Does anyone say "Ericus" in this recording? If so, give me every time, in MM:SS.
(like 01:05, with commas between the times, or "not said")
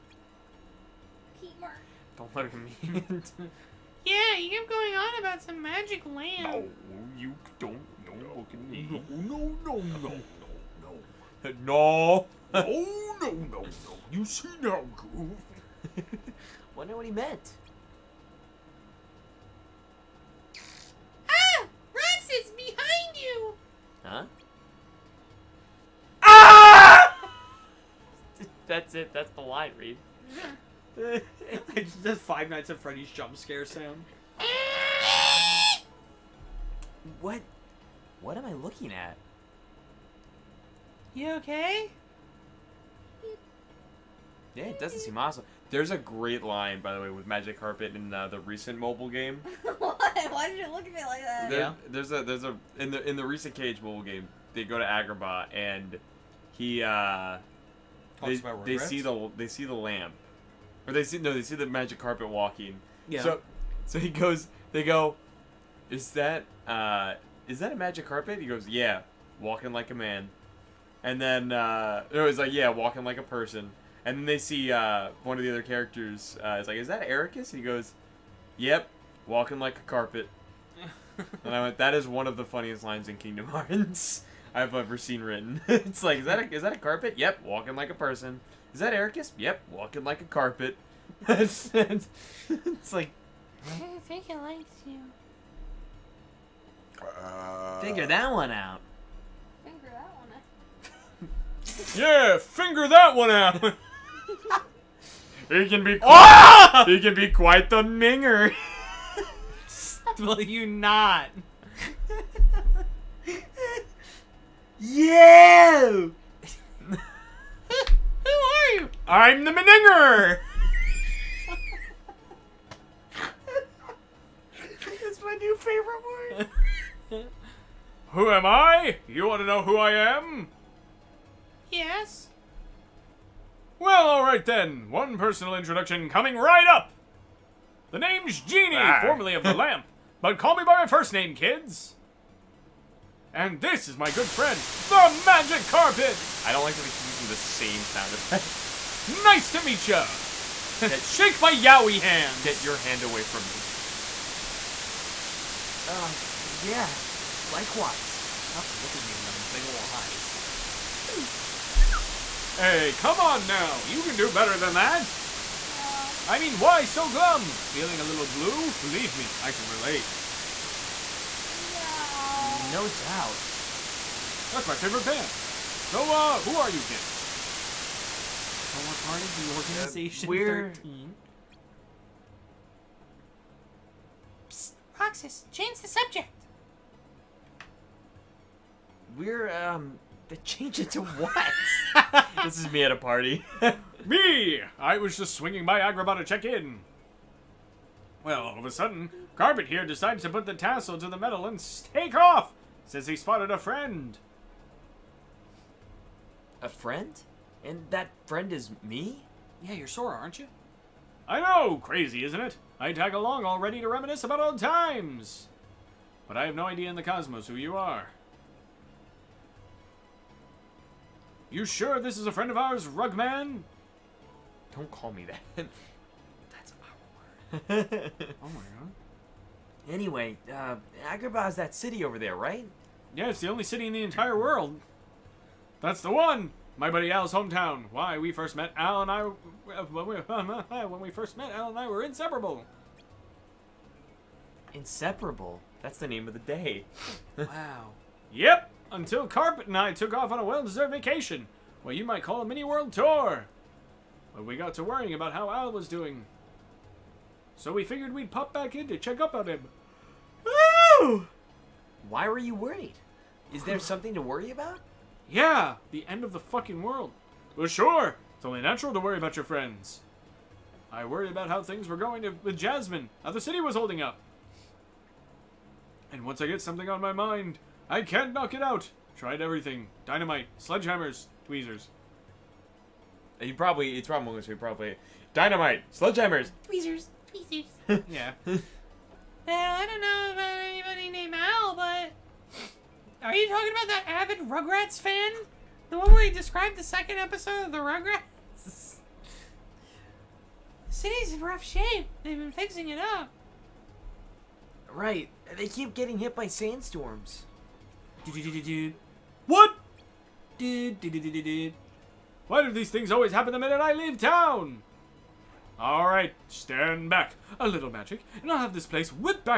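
01:17, 01:28.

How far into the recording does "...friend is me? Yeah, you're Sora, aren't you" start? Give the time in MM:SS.
03:28.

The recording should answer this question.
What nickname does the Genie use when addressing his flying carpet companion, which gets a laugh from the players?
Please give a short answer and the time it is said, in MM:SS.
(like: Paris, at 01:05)
Rugman, at 03:42.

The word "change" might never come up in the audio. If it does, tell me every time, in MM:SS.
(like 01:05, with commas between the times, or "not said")
03:05, 03:10.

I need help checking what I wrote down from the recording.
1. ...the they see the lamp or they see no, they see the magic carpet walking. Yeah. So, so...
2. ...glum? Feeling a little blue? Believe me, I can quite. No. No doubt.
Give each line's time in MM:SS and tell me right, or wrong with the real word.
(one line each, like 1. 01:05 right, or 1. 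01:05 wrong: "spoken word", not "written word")
1. 00:59 right
2. 02:47 wrong: "relate", not "quite".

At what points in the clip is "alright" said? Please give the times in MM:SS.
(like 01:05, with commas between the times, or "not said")
02:14, 05:15.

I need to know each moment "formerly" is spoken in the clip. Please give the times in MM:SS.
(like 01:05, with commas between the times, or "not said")
02:19.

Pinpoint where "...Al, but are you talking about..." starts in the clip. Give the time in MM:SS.
04:51.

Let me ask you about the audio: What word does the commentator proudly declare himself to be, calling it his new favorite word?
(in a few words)
Meninger.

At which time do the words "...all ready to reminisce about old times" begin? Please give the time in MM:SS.
03:33.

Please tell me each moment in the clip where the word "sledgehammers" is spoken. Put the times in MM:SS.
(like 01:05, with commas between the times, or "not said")
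04:40, 04:45.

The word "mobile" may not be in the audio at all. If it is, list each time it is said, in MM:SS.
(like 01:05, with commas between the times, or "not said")
00:48, 00:53.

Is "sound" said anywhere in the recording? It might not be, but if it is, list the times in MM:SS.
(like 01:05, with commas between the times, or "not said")
00:33, 02:27.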